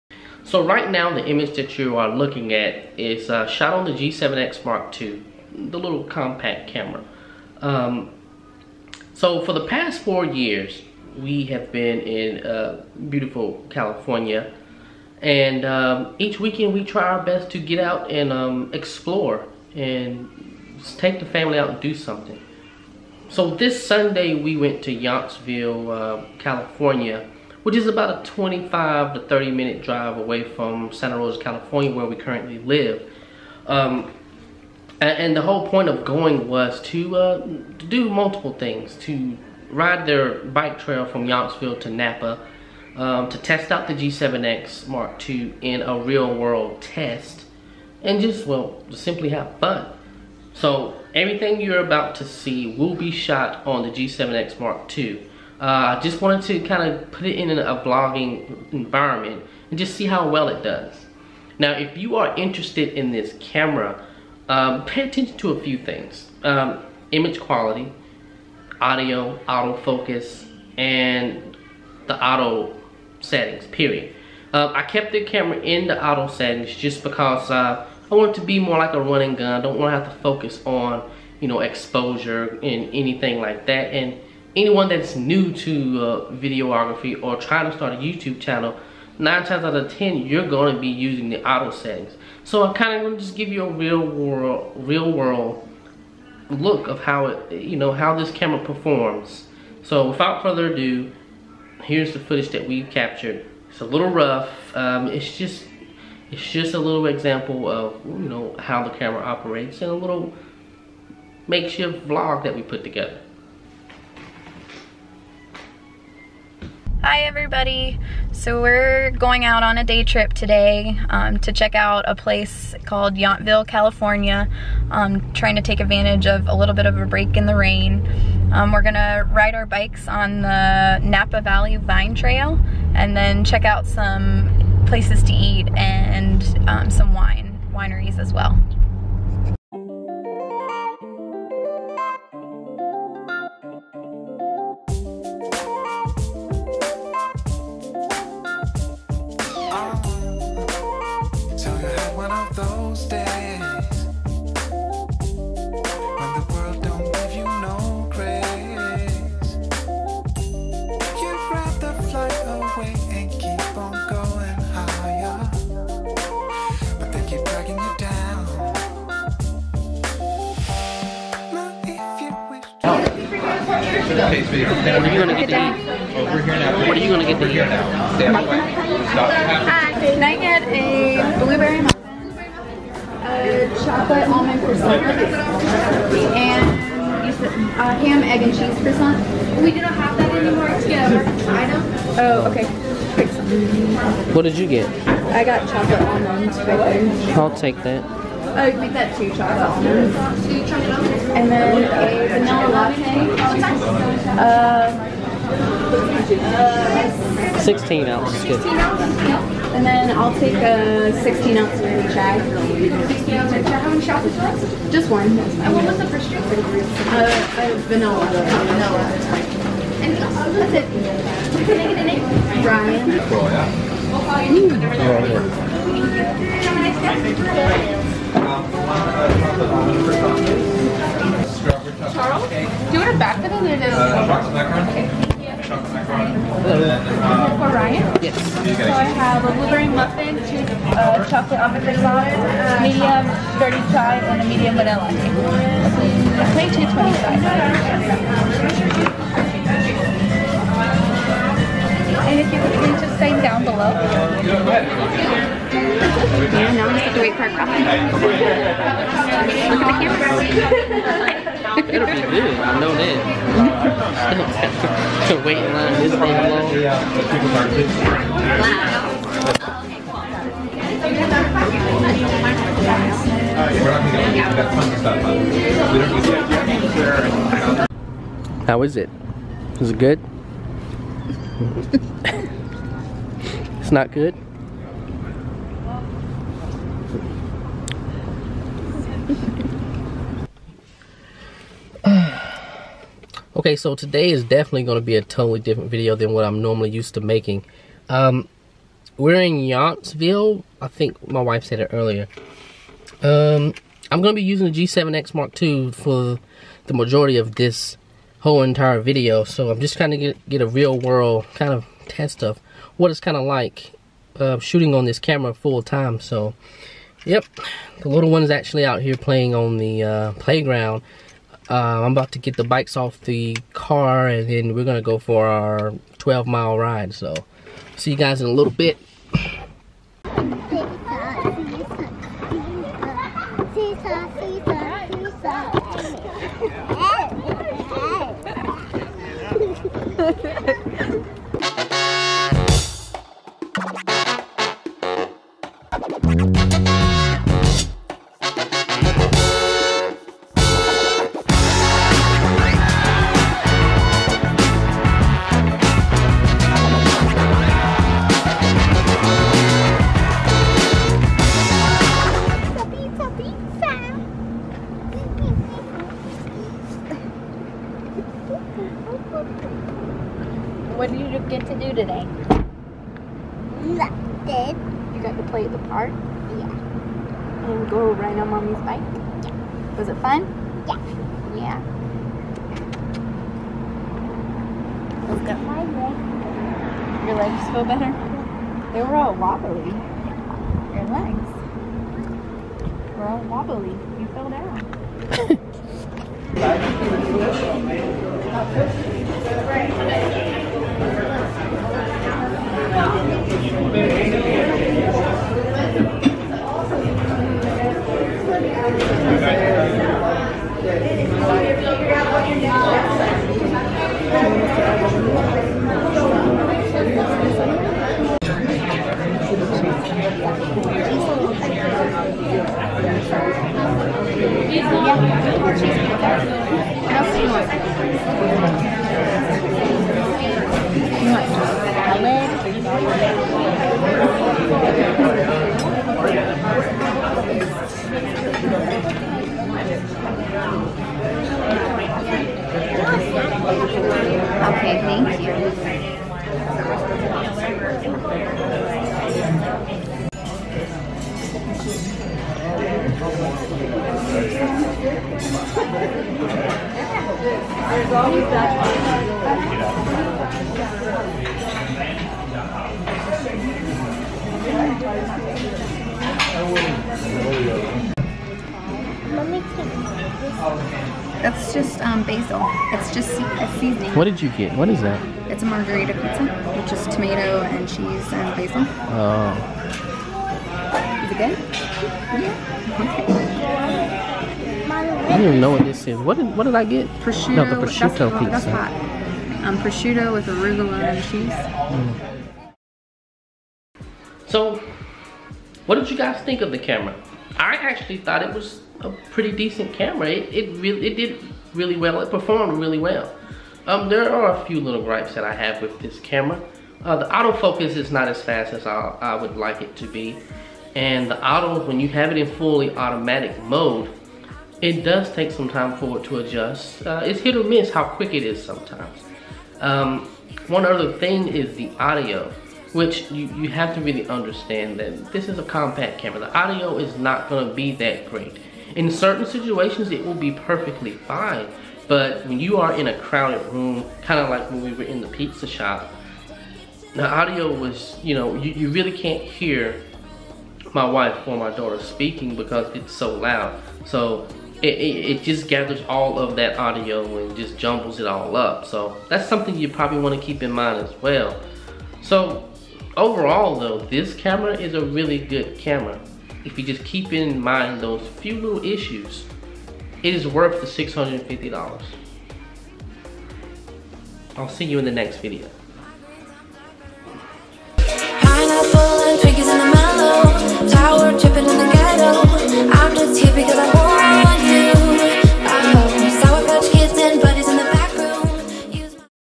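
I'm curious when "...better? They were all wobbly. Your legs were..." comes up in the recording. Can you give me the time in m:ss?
6:27.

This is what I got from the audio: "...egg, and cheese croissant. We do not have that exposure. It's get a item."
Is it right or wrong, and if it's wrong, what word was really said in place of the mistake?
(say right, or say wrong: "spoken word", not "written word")
wrong: "anymore", not "exposure".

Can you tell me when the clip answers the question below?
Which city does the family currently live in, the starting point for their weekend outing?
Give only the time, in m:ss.
0:30.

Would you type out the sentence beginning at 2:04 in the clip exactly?
Um, trying to take advantage of a little bit of a break in the rain.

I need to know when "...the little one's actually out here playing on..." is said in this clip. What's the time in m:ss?
5:17.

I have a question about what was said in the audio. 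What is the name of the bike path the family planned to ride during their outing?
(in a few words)
Napa Valley Vine Trail.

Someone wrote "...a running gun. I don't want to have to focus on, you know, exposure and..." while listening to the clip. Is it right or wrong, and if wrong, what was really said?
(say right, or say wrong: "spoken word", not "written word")
right.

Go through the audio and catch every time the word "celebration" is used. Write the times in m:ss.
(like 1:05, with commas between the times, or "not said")
not said.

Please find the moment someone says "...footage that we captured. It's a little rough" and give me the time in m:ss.
1:42.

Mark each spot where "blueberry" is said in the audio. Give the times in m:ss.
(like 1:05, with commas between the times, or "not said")
3:01, 3:59.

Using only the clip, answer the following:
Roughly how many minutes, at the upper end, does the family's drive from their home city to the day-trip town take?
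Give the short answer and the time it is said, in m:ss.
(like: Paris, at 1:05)
30, at 0:28.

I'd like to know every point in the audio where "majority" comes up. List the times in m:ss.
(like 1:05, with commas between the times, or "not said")
5:06.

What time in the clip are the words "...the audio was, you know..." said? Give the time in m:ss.
8:57.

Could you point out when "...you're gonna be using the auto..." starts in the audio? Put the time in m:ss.
1:30.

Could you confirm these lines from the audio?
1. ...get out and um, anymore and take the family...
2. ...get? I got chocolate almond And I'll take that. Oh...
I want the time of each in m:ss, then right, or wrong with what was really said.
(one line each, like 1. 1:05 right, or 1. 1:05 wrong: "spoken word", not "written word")
1. 0:17 wrong: "explore", not "anymore"
2. 3:14 wrong: "Right", not "And".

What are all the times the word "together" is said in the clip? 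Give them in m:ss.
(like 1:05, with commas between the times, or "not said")
1:52.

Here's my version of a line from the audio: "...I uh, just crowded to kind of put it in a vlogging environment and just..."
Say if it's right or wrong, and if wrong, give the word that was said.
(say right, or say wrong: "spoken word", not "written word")
wrong: "wanted", not "crowded".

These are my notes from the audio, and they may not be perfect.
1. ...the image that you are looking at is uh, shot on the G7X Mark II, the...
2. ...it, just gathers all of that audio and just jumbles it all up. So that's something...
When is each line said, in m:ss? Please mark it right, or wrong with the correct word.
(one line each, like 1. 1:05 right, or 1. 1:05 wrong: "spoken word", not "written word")
1. 0:01 right
2. 9:05 right.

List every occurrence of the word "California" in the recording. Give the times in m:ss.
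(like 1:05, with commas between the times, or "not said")
0:13, 0:26, 0:31, 2:03.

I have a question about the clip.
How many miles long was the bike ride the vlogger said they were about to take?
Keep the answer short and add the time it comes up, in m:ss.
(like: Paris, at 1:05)
12, at 5:26.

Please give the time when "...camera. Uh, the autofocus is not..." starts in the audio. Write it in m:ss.
8:26.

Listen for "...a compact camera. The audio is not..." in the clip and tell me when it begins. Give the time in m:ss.
8:45.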